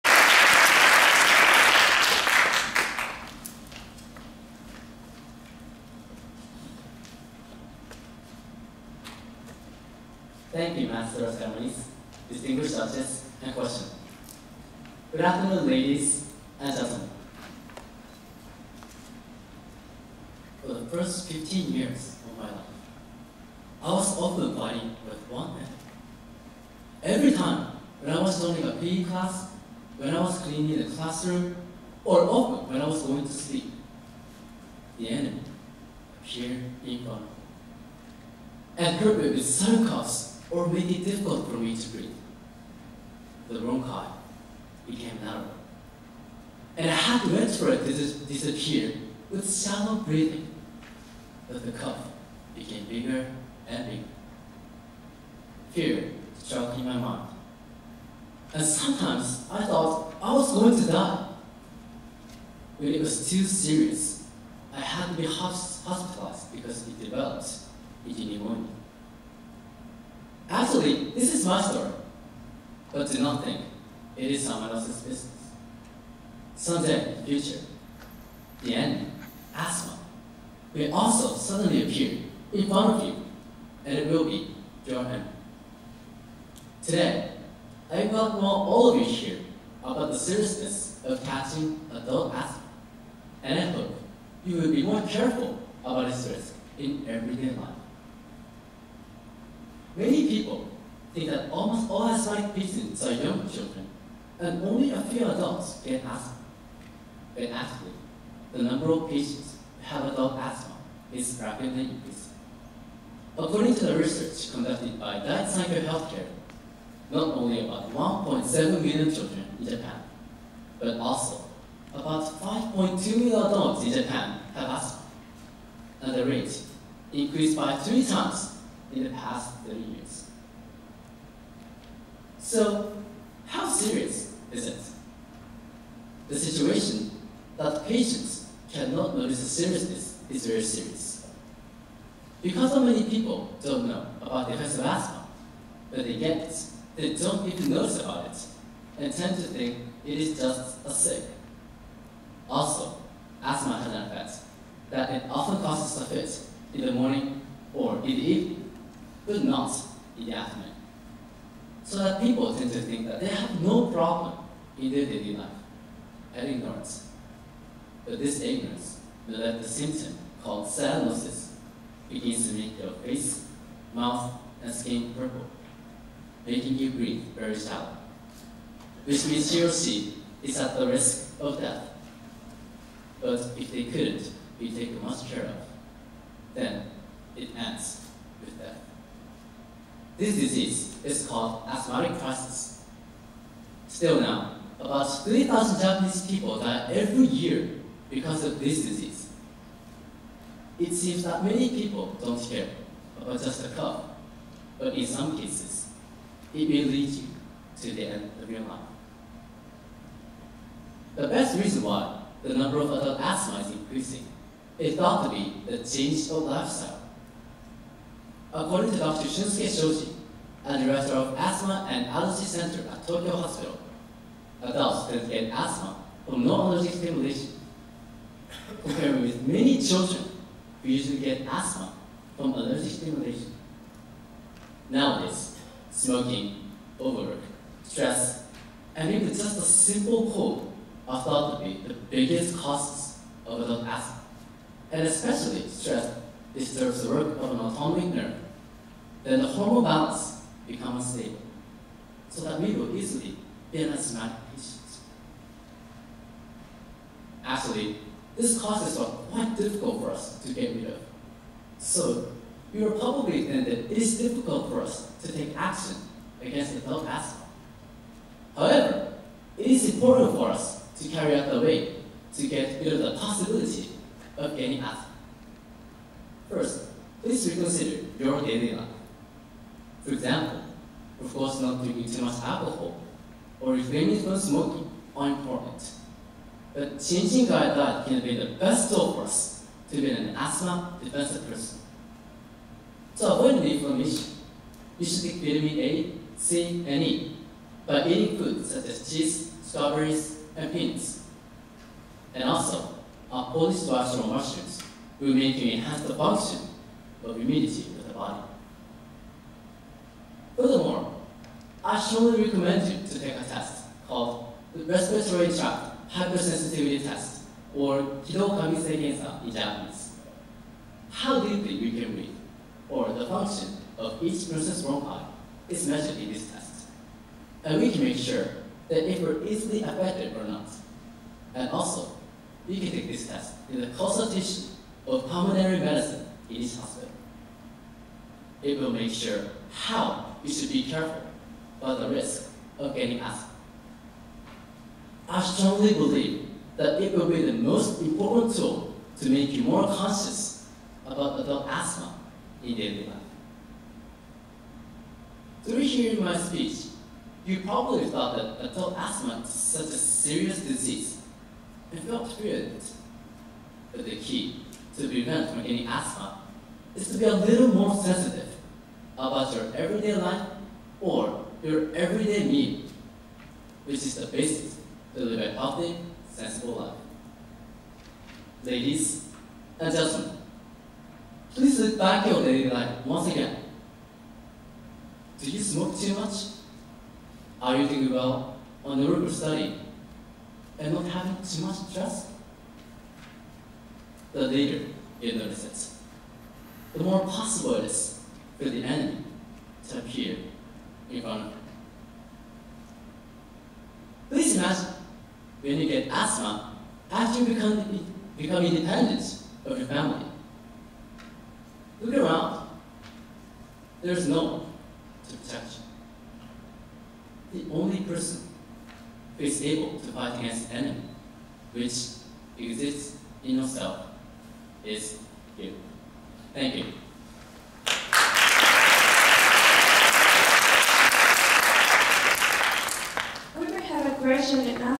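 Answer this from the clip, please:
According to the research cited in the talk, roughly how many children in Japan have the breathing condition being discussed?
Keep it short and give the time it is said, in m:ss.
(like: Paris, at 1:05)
1.7 million, at 1:57.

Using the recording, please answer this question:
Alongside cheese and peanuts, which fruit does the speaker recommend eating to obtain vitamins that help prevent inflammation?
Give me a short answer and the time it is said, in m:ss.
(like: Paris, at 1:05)
strawberries, at 4:59.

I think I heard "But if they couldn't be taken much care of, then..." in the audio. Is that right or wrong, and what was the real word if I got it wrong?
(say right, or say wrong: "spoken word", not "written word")
right.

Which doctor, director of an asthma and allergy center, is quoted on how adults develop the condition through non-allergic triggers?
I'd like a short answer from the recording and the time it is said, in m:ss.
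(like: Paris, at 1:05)
Shunsuke Shoji, at 3:39.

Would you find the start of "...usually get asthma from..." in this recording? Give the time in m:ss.
3:50.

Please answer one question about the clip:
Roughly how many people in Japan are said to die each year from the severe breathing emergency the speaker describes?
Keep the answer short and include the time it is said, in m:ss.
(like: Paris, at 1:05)
3,000, at 3:15.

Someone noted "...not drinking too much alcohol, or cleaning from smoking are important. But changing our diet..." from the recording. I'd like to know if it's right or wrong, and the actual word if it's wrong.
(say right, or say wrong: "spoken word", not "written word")
wrong: "refraining", not "cleaning".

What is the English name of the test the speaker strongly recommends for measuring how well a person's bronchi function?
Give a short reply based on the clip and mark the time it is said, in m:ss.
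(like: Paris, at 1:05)
Respiratory Tract Hypersensitivity Test, at 5:14.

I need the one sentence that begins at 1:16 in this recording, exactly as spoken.
Someday, future, the end, asthma, will also suddenly appear in front of you, and it will be your end.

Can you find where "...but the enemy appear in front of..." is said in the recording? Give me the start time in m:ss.
6:38.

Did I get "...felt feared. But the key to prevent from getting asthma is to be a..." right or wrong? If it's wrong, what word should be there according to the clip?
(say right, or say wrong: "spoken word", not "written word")
right.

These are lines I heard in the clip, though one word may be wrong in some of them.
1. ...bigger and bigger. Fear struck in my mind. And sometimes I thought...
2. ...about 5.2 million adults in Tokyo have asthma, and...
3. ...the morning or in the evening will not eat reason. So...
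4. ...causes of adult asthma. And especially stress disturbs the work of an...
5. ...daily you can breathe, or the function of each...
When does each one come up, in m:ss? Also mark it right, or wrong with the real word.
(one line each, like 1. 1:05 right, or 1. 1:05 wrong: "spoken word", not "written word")
1. 0:52 right
2. 2:01 wrong: "Japan", not "Tokyo"
3. 2:36 wrong: "afternoon", not "reason"
4. 4:02 right
5. 5:21 wrong: "deeply", not "daily".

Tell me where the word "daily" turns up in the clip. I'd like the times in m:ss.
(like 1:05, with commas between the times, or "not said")
2:45, 4:38, 5:52, 6:22.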